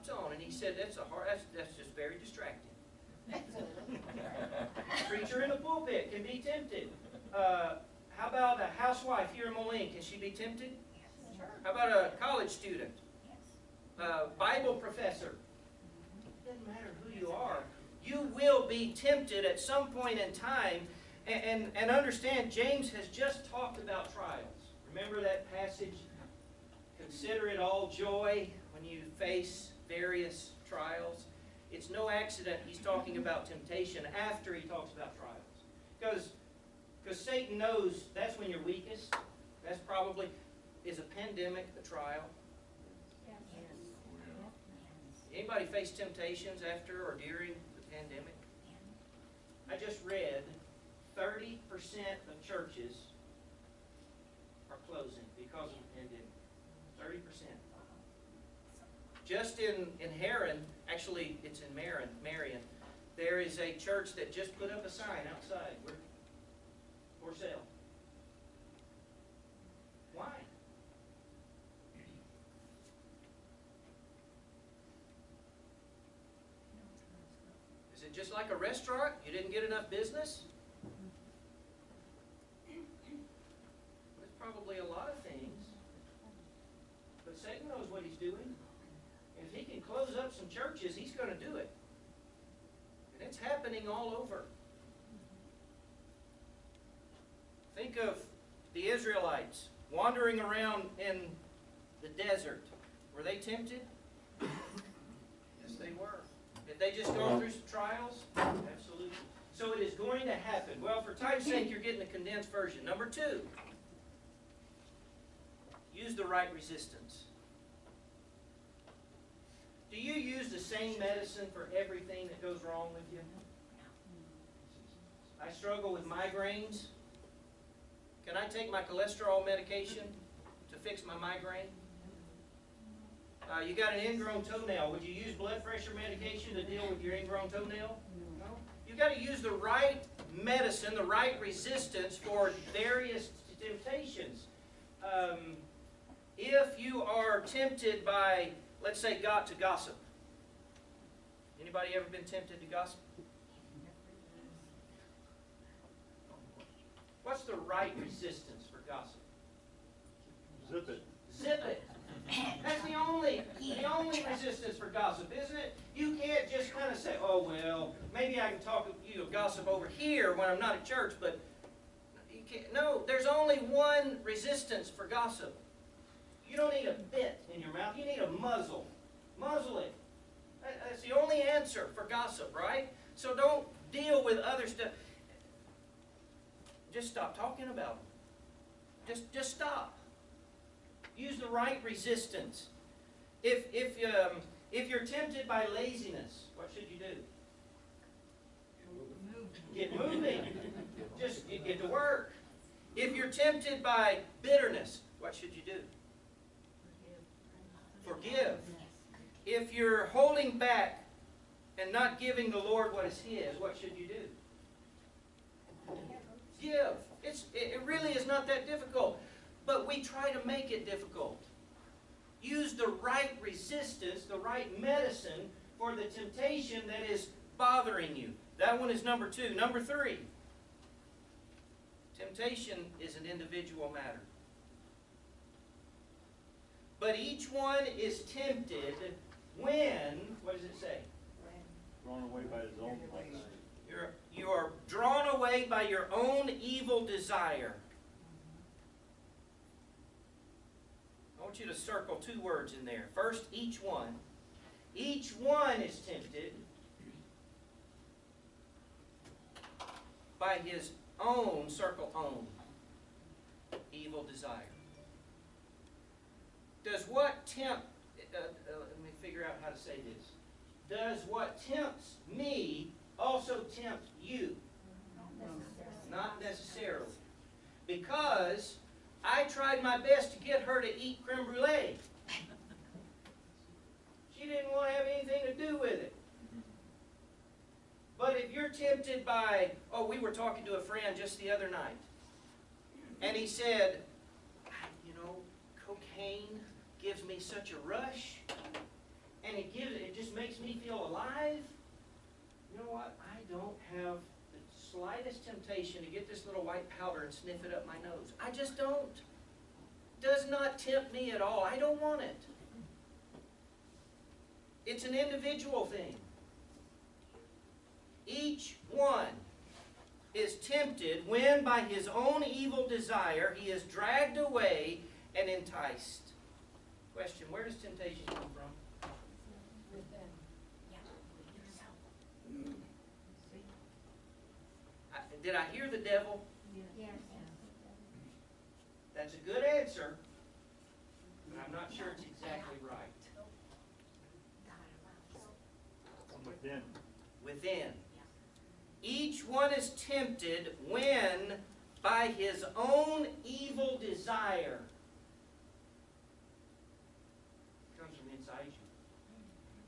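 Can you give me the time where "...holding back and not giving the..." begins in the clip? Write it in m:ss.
3:30.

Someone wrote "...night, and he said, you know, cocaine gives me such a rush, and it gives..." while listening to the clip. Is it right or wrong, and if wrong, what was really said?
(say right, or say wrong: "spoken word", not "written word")
right.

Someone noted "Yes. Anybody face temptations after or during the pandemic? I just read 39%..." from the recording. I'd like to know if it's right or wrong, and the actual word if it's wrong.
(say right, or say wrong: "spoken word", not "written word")
wrong: "30", not "39".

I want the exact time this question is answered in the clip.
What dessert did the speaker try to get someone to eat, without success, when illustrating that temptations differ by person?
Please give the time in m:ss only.
4:41.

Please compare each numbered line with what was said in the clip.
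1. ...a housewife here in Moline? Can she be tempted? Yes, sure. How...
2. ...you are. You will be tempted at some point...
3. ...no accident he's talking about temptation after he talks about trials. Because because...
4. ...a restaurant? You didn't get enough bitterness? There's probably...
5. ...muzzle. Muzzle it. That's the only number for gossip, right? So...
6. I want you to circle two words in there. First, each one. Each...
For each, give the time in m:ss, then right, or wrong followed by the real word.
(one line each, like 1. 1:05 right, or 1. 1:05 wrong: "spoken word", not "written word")
1. 0:08 right
2. 0:17 right
3. 0:31 right
4. 1:18 wrong: "business", not "bitterness"
5. 2:58 wrong: "answer", not "number"
6. 4:11 right.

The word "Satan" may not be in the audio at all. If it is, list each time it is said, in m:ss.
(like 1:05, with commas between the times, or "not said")
0:37, 1:27.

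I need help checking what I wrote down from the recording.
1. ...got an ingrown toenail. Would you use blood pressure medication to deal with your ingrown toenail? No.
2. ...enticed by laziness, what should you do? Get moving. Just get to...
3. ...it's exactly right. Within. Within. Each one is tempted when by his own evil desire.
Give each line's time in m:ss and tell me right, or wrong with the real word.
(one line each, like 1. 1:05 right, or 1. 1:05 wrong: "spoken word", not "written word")
1. 2:13 right
2. 3:15 wrong: "tempted", not "enticed"
3. 5:42 right.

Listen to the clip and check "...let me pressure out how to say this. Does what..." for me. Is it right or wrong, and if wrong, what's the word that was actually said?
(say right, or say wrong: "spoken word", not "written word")
wrong: "figure", not "pressure".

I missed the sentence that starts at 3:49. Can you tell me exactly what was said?
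Number three, temptation is an individual matter.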